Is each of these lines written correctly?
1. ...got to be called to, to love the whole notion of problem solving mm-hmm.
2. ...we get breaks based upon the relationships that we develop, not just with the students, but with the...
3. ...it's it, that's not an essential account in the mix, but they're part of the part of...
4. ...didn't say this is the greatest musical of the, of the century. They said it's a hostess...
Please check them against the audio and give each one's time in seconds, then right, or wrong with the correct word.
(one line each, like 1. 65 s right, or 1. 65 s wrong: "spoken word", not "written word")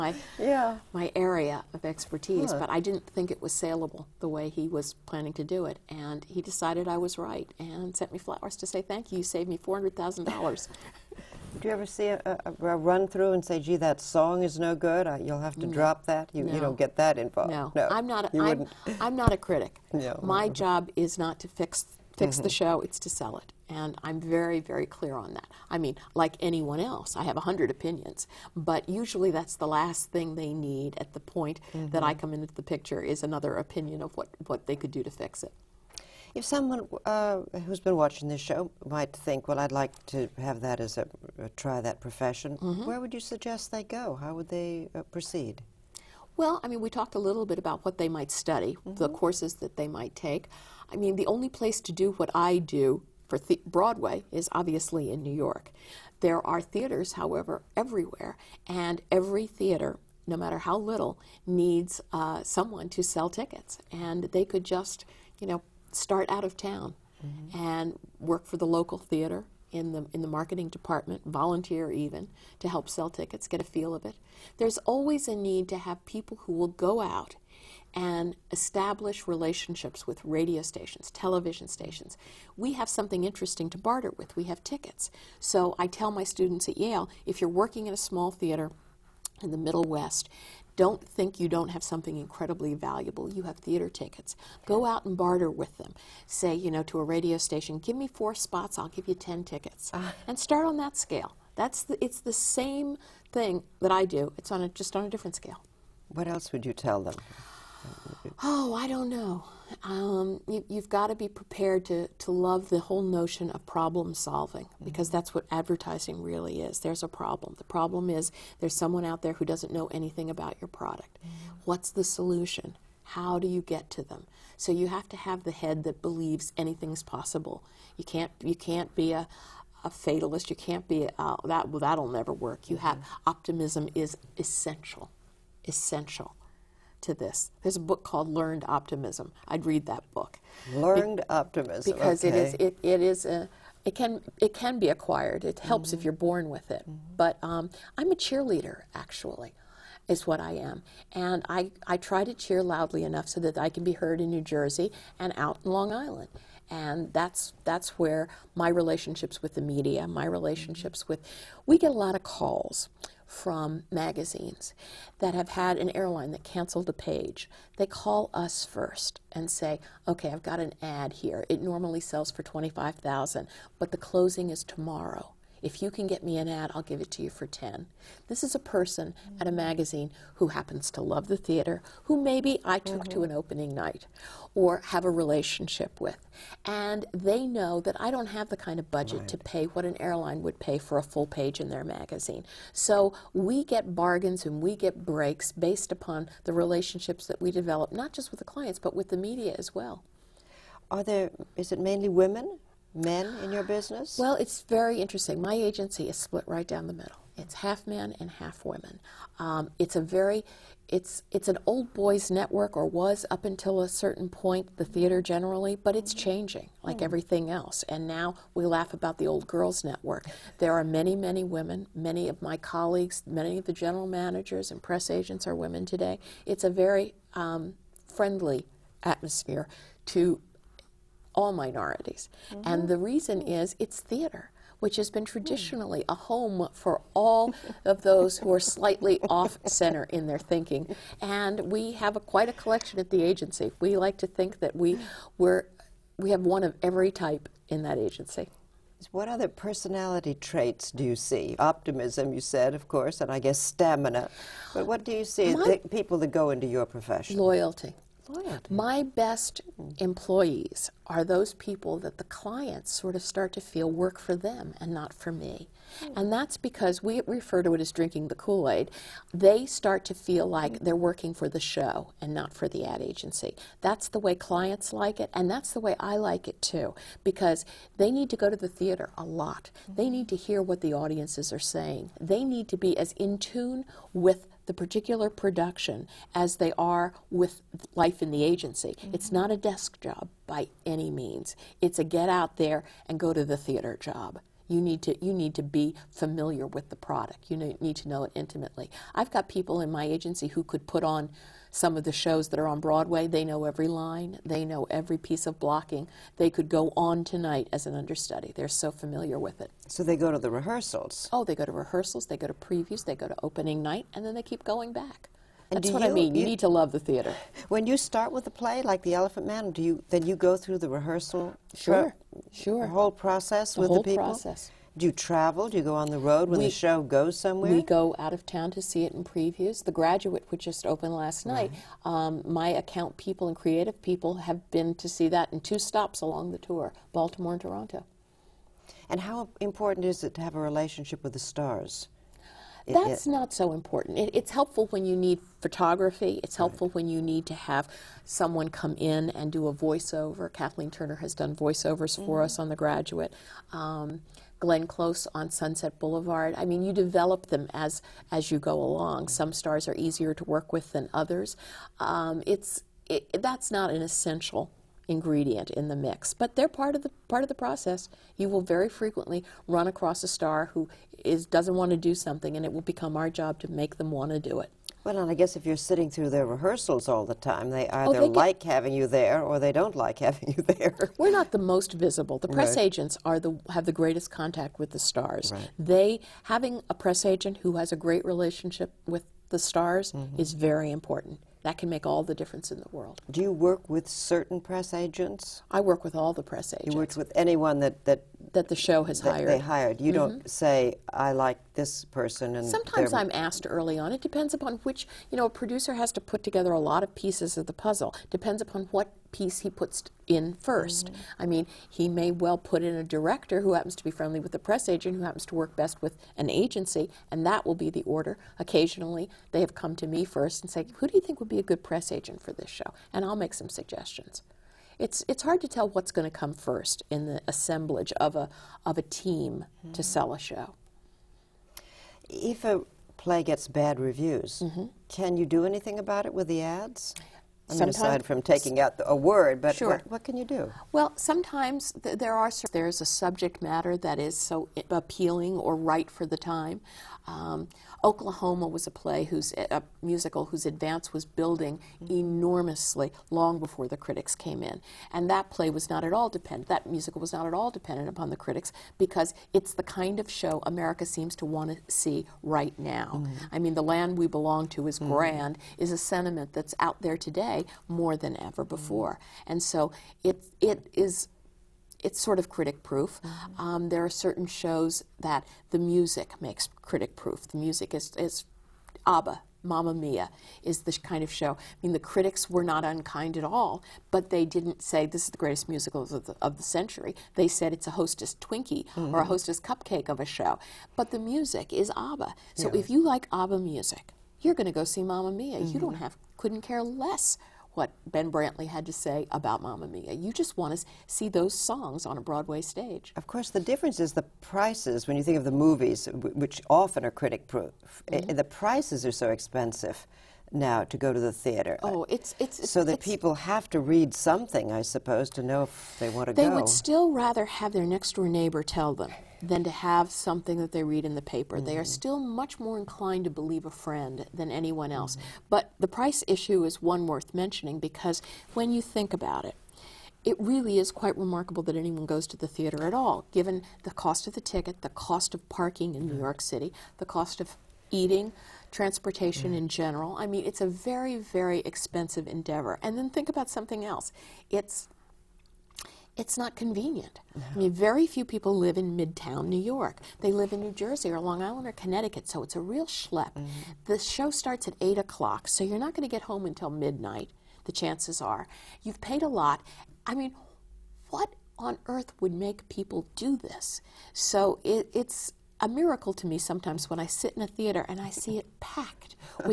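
1. 110 s wrong: "prepared", not "called"
2. 194 s wrong: "clients", not "students"
3. 362 s wrong: "ingredient", not "account"
4. 484 s right.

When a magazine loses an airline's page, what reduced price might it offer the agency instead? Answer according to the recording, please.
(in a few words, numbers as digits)
10,000.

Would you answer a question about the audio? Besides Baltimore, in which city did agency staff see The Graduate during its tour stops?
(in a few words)
Toronto.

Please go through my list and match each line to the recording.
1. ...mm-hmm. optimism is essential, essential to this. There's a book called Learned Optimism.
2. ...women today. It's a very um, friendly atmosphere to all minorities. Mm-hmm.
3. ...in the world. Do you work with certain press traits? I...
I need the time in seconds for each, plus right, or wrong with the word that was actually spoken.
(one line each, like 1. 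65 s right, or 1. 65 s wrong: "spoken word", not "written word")
1. 132 s right
2. 225 s right
3. 392 s wrong: "agents", not "traits".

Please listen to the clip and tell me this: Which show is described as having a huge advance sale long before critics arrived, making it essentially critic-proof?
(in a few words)
Oklahoma.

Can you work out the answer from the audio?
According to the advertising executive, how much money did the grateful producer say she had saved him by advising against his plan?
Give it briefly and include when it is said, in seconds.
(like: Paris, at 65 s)
$400,000, at 9 s.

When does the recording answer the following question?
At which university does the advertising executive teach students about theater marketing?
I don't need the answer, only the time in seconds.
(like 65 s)
86 s.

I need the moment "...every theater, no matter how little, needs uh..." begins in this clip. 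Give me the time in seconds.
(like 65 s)
59 s.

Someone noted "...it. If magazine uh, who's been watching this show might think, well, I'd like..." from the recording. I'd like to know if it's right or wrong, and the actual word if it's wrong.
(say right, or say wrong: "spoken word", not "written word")
wrong: "someone", not "magazine".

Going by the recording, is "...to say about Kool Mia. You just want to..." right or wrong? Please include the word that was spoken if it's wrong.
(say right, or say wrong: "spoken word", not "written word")
wrong: "Mamma", not "Kool".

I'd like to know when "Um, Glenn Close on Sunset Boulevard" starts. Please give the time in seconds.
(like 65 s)
353 s.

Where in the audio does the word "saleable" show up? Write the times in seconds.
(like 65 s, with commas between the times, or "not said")
3 s.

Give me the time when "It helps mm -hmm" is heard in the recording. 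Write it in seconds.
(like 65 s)
145 s.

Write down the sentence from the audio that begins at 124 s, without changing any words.
So you have to have the head that believes anything's possible.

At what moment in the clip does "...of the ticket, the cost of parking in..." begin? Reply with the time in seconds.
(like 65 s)
534 s.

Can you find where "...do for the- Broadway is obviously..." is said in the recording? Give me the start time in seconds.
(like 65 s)
52 s.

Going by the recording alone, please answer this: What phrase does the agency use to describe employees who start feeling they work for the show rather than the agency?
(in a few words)
drinking the Kool Aid.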